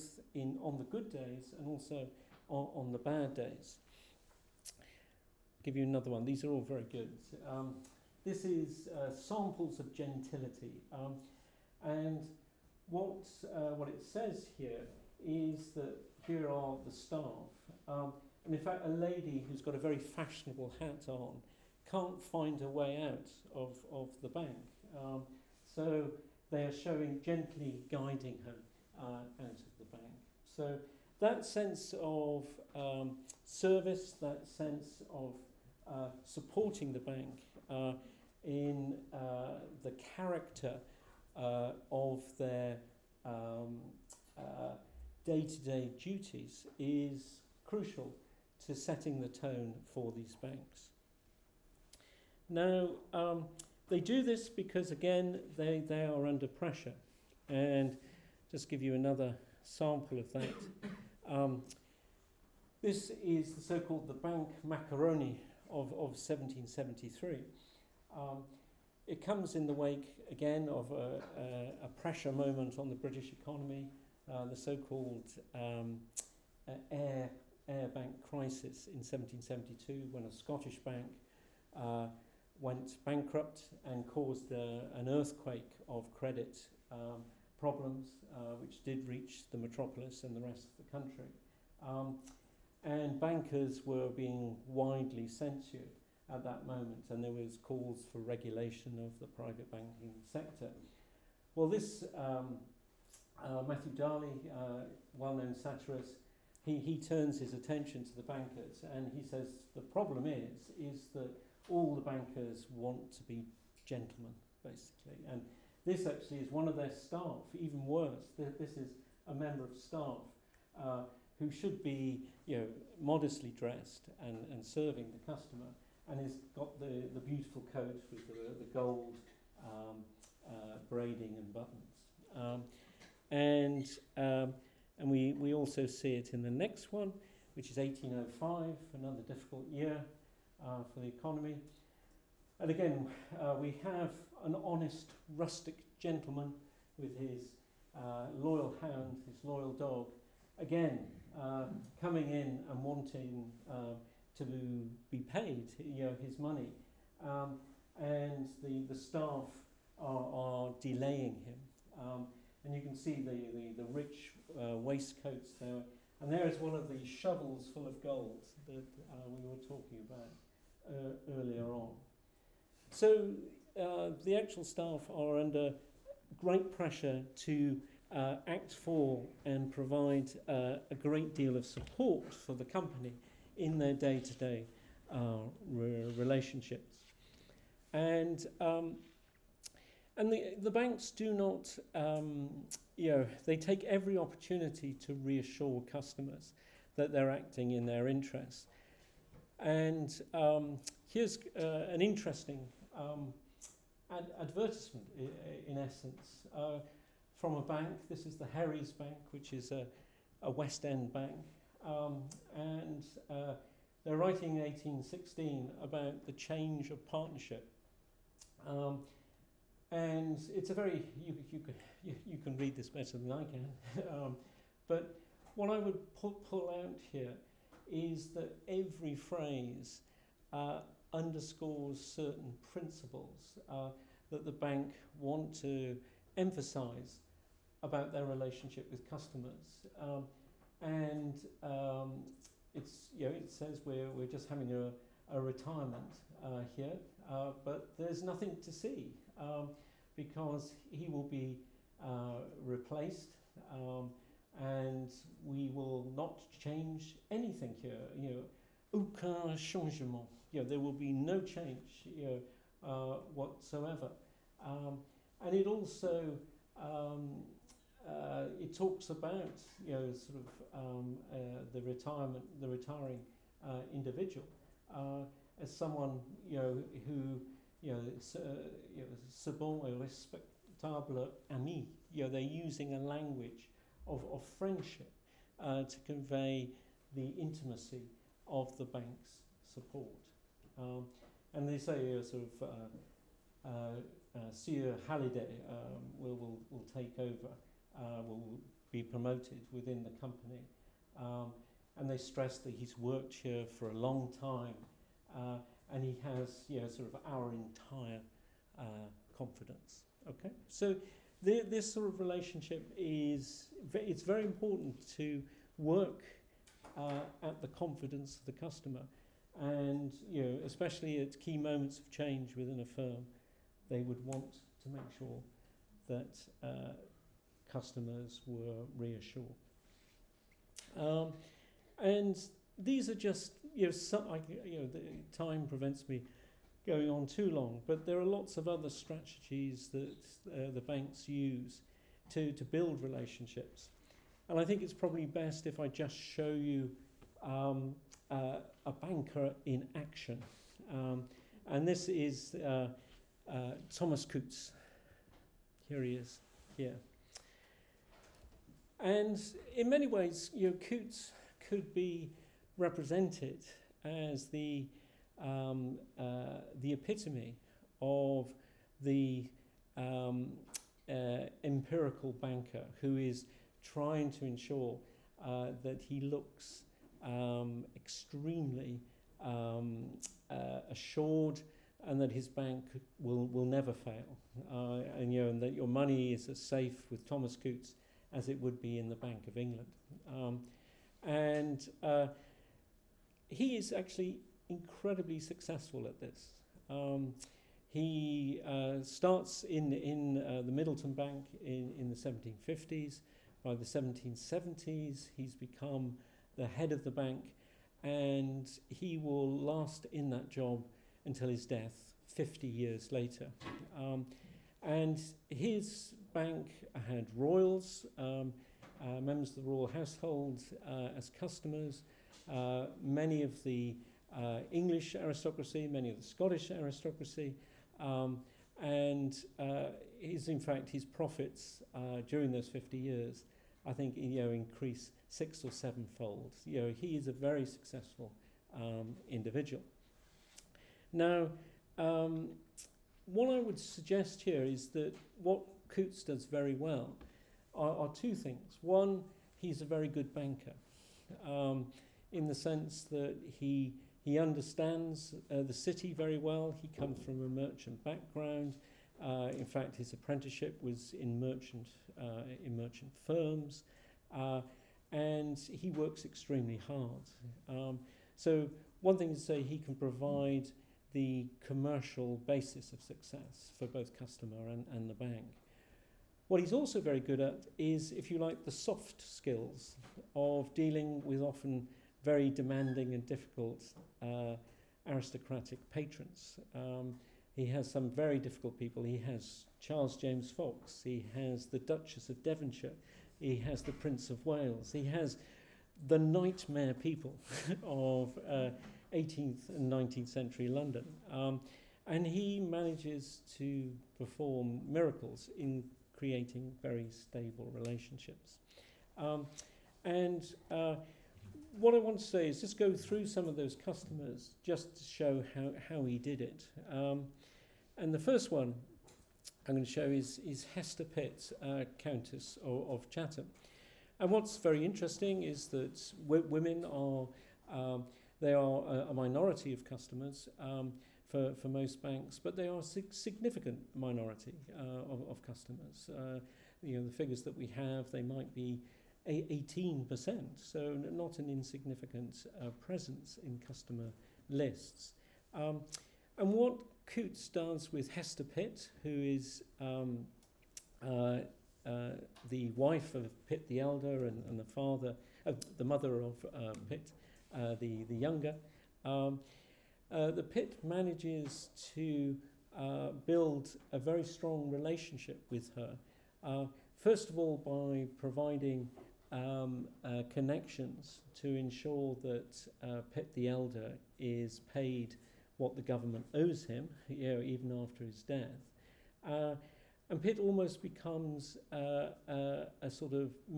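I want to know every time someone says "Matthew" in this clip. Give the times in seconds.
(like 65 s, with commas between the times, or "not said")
103 s.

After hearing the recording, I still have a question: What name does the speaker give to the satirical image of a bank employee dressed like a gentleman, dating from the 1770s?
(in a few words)
The bank macaroni.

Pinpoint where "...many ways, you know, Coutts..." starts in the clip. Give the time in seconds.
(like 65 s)
359 s.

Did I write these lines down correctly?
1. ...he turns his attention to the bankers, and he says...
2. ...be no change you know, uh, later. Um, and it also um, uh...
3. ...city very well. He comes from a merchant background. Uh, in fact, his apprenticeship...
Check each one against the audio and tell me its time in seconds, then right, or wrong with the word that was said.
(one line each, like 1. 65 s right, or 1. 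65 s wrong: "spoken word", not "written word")
1. 106 s right
2. 260 s wrong: "whatsoever", not "later"
3. 455 s right.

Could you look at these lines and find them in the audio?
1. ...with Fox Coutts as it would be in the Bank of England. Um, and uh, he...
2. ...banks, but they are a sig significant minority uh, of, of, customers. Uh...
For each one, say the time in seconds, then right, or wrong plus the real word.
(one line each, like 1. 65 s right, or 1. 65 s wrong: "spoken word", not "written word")
1. 387 s wrong: "Thomas", not "Fox"
2. 532 s right.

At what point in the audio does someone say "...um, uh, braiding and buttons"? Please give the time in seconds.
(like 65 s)
129 s.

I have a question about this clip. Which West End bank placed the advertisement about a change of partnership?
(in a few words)
Herries Bank.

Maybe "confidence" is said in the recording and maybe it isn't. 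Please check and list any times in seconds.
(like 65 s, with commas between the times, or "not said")
309 s, 317 s.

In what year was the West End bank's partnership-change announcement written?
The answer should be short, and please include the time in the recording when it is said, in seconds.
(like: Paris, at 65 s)
1816, at 214 s.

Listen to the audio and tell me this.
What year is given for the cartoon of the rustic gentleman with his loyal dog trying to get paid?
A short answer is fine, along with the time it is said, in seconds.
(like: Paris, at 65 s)
1805, at 137 s.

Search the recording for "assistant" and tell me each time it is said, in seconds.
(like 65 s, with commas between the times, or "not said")
not said.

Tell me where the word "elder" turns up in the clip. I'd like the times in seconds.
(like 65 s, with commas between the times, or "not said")
553 s, 573 s.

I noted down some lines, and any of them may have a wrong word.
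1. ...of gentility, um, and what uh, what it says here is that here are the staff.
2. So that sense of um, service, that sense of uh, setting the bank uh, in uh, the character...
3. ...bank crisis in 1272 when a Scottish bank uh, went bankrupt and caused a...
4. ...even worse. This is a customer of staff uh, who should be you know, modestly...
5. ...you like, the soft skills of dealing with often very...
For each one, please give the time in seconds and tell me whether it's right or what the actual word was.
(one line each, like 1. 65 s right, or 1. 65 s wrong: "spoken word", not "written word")
1. 9 s right
2. 30 s wrong: "supporting", not "setting"
3. 77 s wrong: "1772", not "1272"
4. 117 s wrong: "member", not "customer"
5. 478 s right.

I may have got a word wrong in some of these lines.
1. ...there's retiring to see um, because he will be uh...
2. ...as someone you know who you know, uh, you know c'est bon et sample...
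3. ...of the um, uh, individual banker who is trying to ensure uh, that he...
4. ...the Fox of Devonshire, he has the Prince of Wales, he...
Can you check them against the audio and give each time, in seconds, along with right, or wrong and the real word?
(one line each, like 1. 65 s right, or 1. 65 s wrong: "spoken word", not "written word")
1. 247 s wrong: "nothing", not "retiring"
2. 275 s wrong: "respectable", not "sample"
3. 368 s wrong: "empirical", not "individual"
4. 491 s wrong: "Duchess", not "Fox".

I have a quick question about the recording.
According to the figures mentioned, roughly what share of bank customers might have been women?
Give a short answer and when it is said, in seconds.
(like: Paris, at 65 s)
18%, at 539 s.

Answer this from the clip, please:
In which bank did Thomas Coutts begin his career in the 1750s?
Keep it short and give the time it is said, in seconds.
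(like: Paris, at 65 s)
The Middleton Bank, at 400 s.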